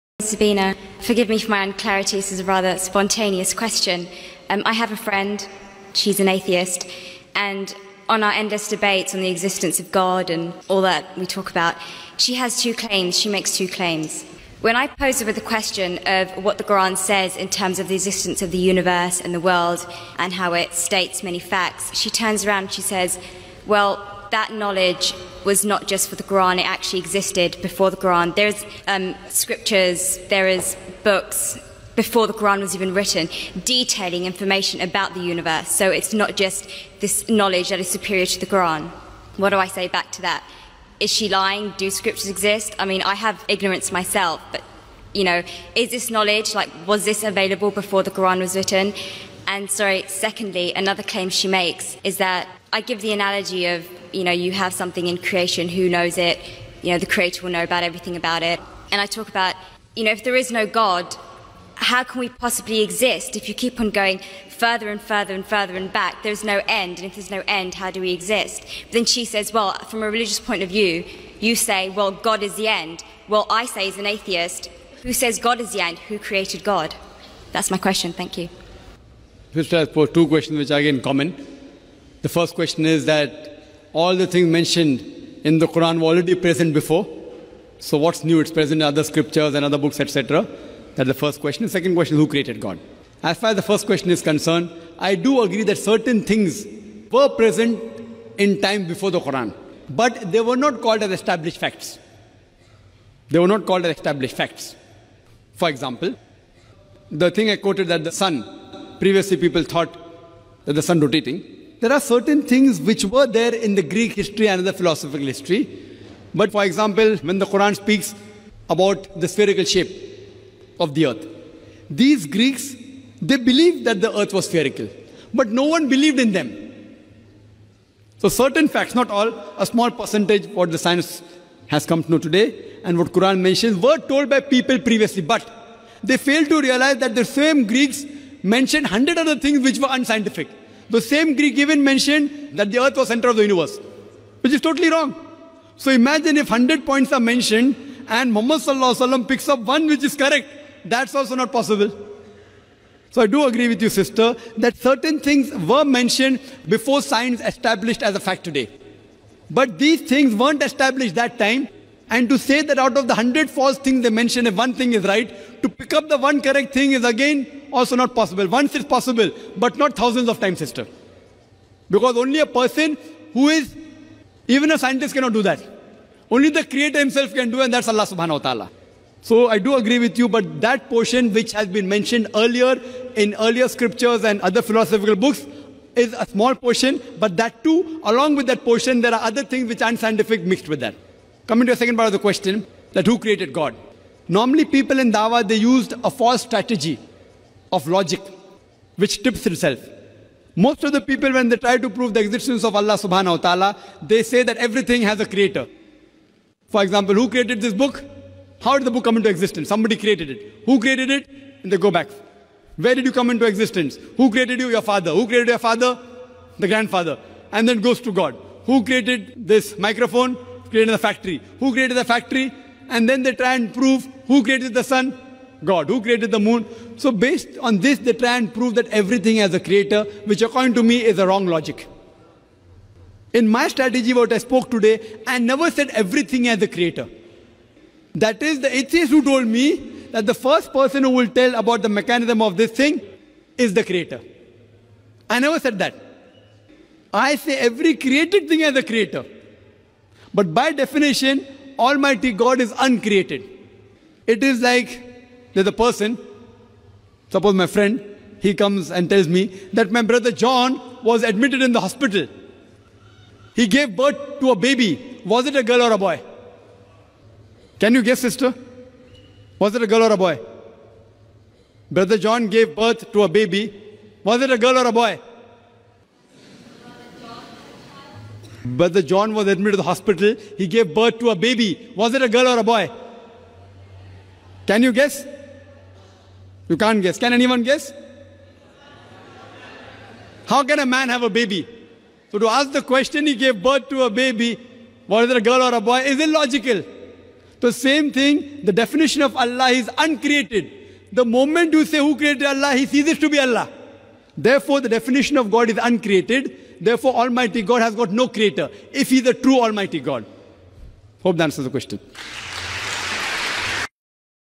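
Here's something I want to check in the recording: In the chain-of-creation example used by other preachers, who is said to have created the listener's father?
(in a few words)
The grandfather.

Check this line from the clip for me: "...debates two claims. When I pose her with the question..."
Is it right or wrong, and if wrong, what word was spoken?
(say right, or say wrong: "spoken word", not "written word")
wrong: "makes", not "debates".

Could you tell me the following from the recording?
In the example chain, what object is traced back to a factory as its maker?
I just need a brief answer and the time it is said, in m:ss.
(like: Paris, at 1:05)
Microphone, at 3:39.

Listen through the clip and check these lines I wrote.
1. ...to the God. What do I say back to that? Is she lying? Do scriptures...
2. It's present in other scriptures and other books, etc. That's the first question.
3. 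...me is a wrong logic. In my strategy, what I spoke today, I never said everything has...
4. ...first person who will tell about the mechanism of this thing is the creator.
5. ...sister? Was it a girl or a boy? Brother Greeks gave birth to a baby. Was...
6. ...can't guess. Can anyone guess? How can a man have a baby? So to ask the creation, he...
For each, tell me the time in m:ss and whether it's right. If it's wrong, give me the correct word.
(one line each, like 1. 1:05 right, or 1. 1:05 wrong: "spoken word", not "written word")
1. 0:38 wrong: "Quran", not "God"
2. 1:28 right
3. 3:50 right
4. 4:00 right
5. 4:28 wrong: "John", not "Greeks"
6. 4:46 wrong: "question", not "creation".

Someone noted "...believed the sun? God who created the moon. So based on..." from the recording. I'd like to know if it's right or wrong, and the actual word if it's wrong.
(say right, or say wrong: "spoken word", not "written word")
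wrong: "created", not "believed".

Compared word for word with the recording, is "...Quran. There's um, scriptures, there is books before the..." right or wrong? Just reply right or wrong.
right.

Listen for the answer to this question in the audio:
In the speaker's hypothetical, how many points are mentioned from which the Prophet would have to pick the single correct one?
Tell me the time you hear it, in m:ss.
2:26.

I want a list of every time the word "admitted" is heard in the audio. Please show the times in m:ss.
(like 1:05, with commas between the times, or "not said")
4:21, 4:39.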